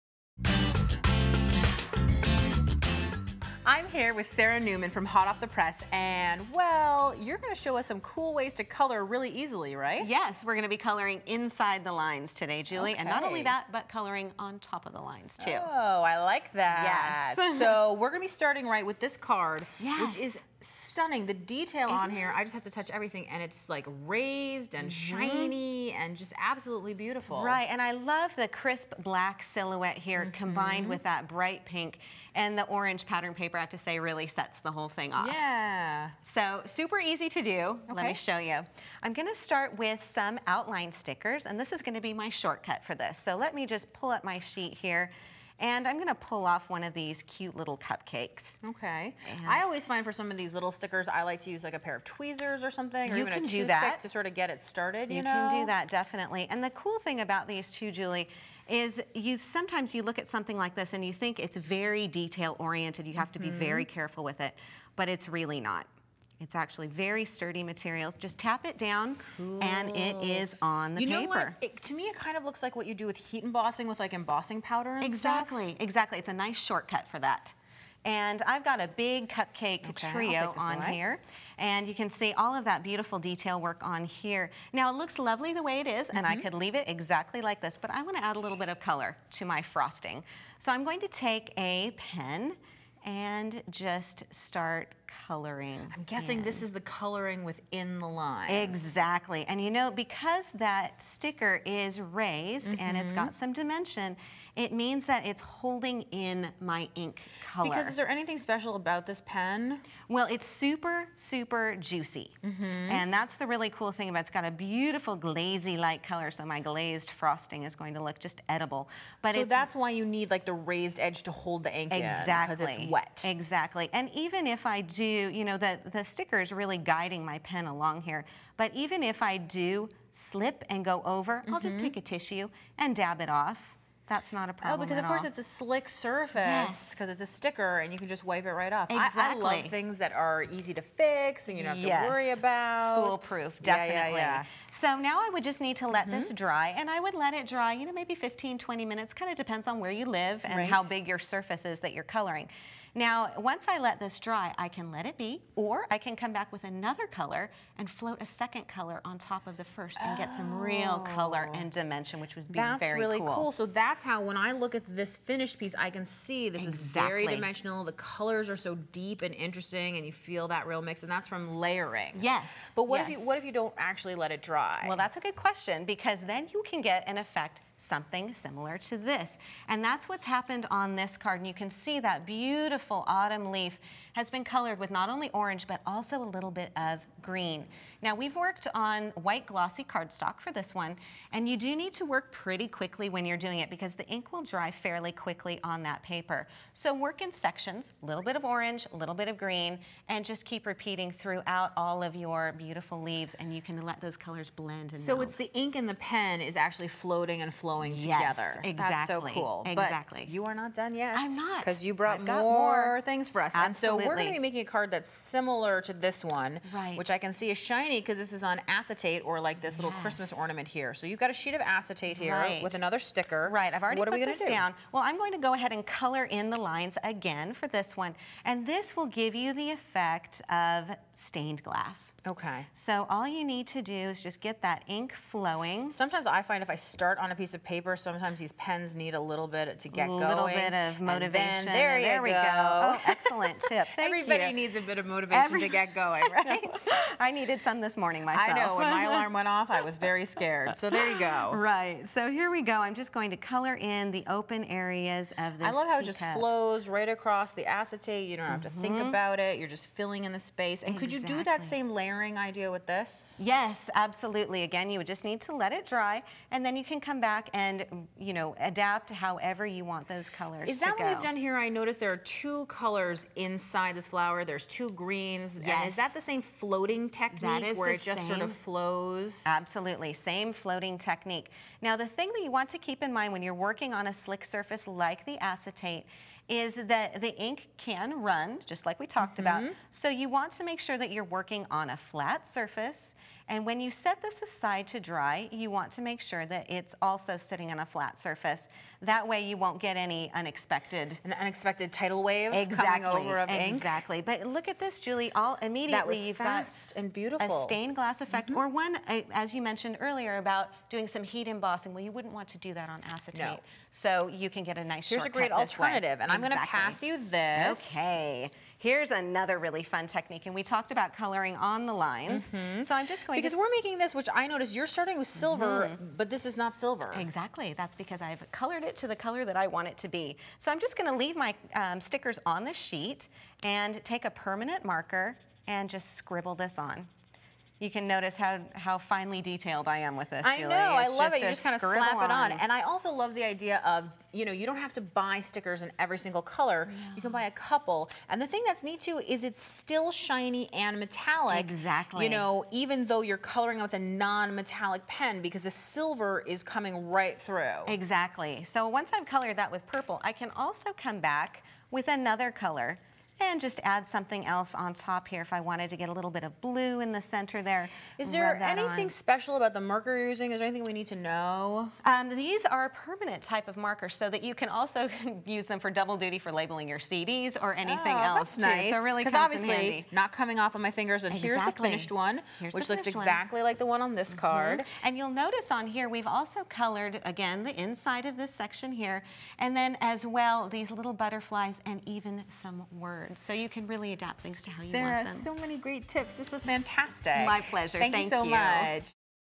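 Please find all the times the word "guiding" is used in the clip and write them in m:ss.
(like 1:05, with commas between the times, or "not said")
2:06.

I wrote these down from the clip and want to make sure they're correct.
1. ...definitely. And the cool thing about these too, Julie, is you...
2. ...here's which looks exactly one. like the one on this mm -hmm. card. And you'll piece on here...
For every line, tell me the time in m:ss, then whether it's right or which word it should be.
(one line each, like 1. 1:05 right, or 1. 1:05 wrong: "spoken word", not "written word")
1. 0:55 right
2. 6:22 wrong: "notice", not "piece".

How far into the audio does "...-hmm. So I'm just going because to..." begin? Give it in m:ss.
5:22.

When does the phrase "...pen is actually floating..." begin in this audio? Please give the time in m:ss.
3:25.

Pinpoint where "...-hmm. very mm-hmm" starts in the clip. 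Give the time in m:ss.
1:03.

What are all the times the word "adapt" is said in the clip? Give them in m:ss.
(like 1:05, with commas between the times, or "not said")
4:28, 6:34.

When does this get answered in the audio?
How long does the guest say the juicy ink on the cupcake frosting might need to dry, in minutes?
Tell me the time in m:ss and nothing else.
2:28.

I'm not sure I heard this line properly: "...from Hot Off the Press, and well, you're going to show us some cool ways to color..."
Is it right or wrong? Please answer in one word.
right.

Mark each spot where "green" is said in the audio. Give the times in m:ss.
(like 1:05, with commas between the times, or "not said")
3:07, 3:19, 4:35.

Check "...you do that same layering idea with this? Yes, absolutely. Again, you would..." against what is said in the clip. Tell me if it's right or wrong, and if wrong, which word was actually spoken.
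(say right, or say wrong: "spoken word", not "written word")
right.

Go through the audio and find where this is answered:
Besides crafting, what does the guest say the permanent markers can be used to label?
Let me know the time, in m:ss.
6:16.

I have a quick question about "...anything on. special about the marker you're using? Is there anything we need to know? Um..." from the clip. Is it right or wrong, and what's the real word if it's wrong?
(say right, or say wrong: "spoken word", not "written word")
right.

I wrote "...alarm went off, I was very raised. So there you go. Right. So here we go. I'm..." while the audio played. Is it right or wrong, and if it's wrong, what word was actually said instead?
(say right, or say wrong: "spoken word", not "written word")
wrong: "scared", not "raised".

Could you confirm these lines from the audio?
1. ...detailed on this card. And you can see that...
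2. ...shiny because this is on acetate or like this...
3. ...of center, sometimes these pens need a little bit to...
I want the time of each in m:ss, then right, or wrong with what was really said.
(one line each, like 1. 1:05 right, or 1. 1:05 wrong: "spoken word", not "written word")
1. 3:00 wrong: "happened", not "detailed"
2. 3:37 right
3. 3:57 wrong: "paper", not "center".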